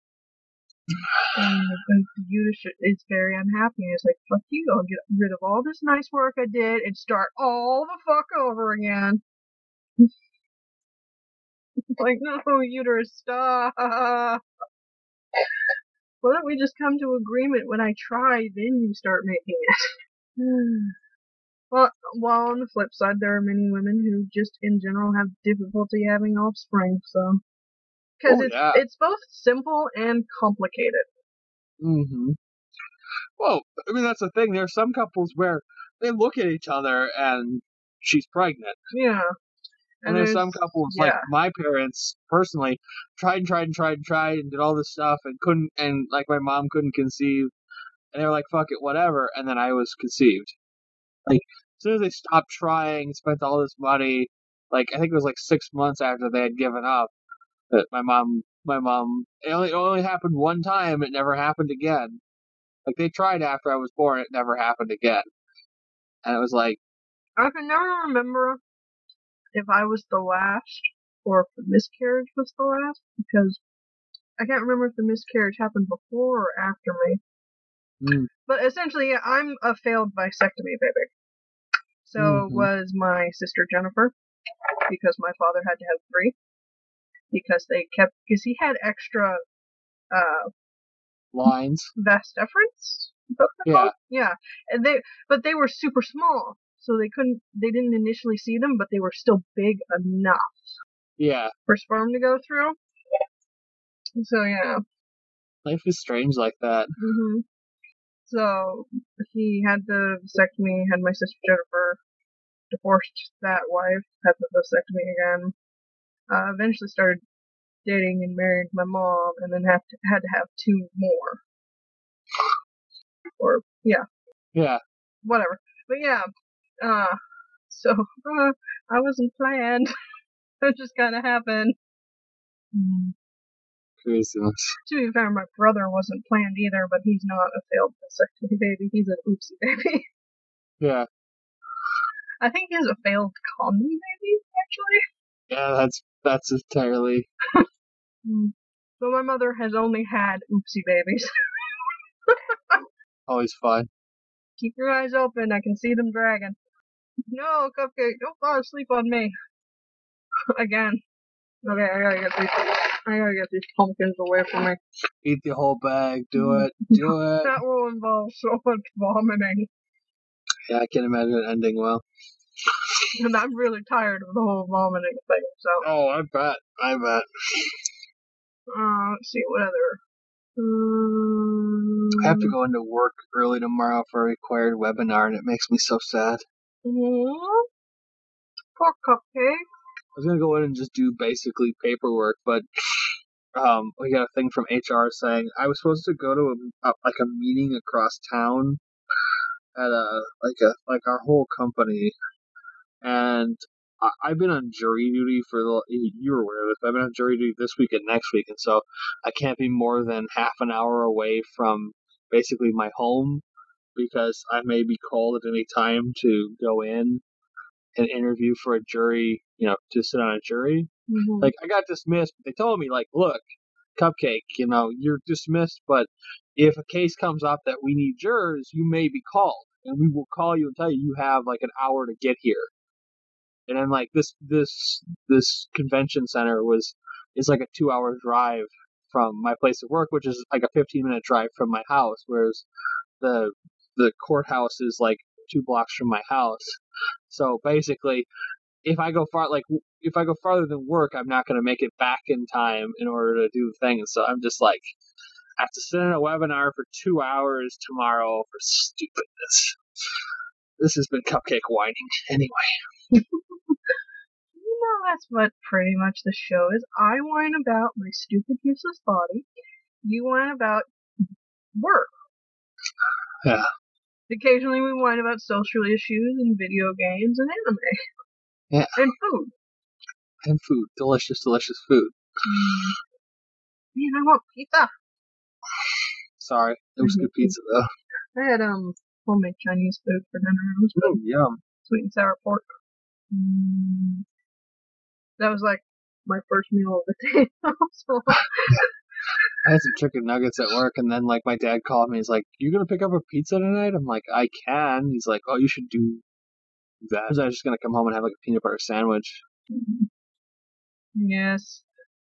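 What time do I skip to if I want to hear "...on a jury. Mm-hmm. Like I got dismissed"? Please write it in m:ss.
3:40.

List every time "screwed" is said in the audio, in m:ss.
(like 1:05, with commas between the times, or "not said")
not said.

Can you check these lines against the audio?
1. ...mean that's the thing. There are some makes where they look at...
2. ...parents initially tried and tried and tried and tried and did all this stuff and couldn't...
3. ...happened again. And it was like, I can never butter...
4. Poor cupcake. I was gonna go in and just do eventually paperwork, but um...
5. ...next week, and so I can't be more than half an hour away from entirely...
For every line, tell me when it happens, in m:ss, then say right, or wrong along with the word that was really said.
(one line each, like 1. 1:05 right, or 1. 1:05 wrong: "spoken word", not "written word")
1. 0:33 wrong: "couples", not "makes"
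2. 0:41 wrong: "personally", not "initially"
3. 1:04 wrong: "remember", not "butter"
4. 3:08 wrong: "basically", not "eventually"
5. 3:28 wrong: "basically", not "entirely".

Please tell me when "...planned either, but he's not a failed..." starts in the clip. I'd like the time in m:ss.
2:16.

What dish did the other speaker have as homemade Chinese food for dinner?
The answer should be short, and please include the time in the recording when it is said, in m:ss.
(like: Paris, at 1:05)
Sweet and sour pork, at 4:51.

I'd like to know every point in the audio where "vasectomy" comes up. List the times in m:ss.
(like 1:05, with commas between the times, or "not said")
1:20, 1:50, 1:54, 2:18.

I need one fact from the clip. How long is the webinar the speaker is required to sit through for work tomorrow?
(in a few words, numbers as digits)
2 hours.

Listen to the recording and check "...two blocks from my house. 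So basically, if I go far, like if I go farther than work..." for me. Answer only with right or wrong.
right.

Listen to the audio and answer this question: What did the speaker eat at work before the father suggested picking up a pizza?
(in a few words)
Chicken nuggets.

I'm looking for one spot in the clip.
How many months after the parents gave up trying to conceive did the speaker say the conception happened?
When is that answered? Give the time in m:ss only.
0:55.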